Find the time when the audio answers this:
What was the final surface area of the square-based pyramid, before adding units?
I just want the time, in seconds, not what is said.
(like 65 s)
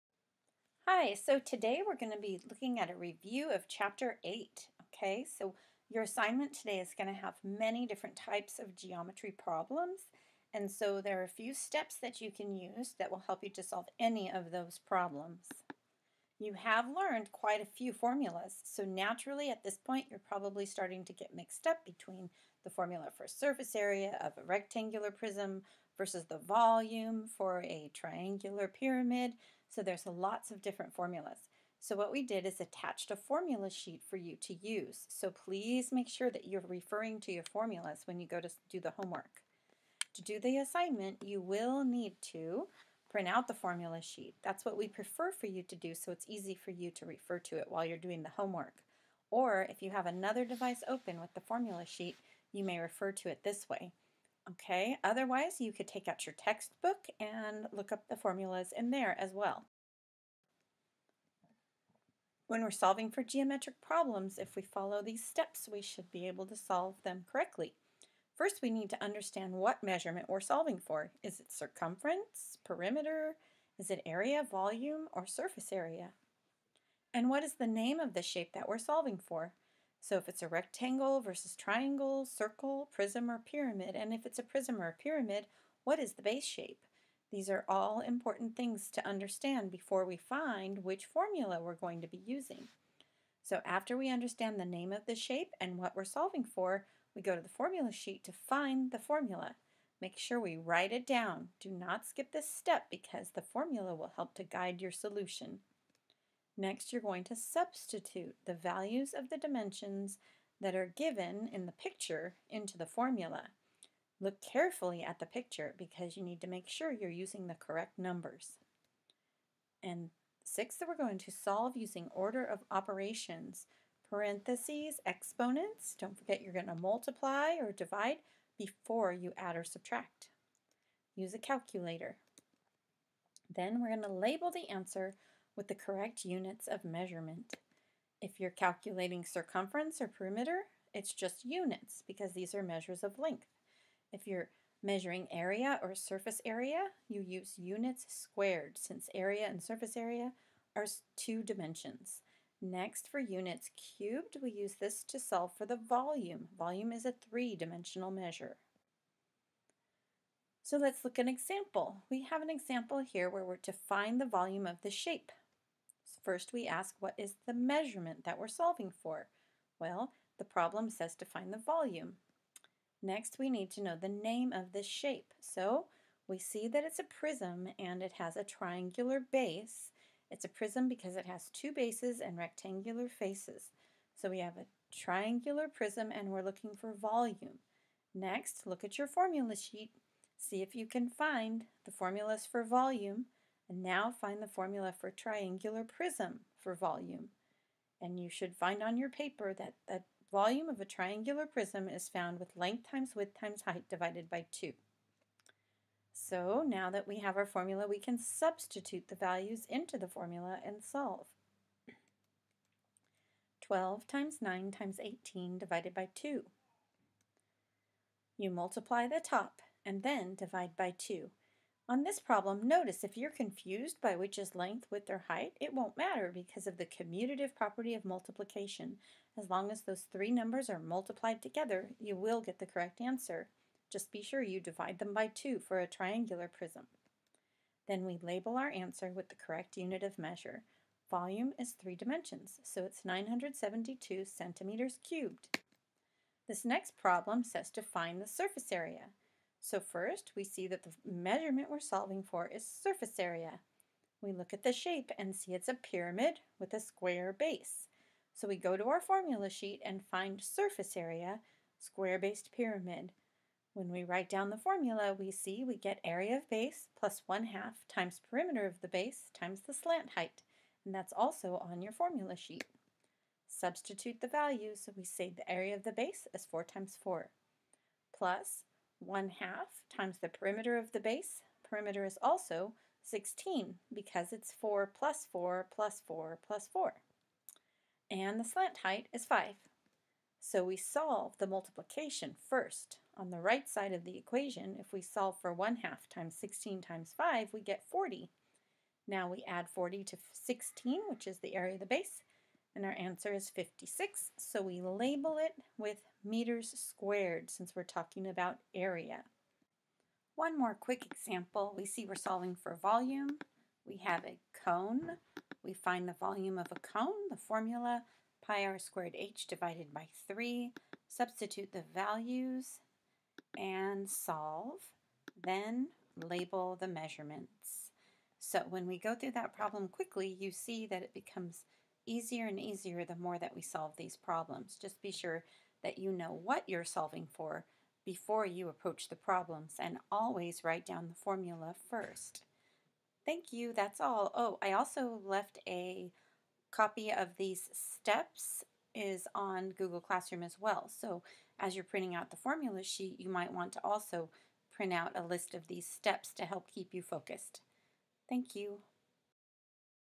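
303 s.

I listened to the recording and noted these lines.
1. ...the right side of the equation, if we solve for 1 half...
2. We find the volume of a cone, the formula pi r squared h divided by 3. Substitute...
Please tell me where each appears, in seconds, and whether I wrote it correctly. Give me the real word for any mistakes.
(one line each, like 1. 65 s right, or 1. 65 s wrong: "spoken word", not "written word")
1. 293 s right
2. 315 s right.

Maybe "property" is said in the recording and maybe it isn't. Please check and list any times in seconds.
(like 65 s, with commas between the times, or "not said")
227 s.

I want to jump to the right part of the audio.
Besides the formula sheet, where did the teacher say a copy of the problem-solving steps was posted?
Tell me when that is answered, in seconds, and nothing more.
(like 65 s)
349 s.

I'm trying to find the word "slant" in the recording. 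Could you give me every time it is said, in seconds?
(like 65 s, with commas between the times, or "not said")
269 s, 288 s.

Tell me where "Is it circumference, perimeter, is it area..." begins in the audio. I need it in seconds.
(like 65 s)
71 s.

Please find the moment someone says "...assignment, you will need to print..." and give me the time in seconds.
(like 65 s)
40 s.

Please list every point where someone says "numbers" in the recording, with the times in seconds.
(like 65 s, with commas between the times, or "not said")
117 s, 230 s.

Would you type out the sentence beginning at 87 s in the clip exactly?
These are all important things to understand before we find which formula we're going to be using.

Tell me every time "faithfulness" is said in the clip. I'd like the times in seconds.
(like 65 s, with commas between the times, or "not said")
not said.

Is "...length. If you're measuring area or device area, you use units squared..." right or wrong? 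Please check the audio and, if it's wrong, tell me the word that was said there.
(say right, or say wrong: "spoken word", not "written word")
wrong: "surface", not "device".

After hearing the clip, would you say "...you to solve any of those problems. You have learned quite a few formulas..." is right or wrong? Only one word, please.
right.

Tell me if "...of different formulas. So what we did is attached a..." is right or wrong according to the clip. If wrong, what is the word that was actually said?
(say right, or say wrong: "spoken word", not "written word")
right.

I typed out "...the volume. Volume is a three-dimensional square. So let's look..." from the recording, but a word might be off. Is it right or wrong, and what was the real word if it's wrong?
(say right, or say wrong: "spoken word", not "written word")
wrong: "measure", not "square".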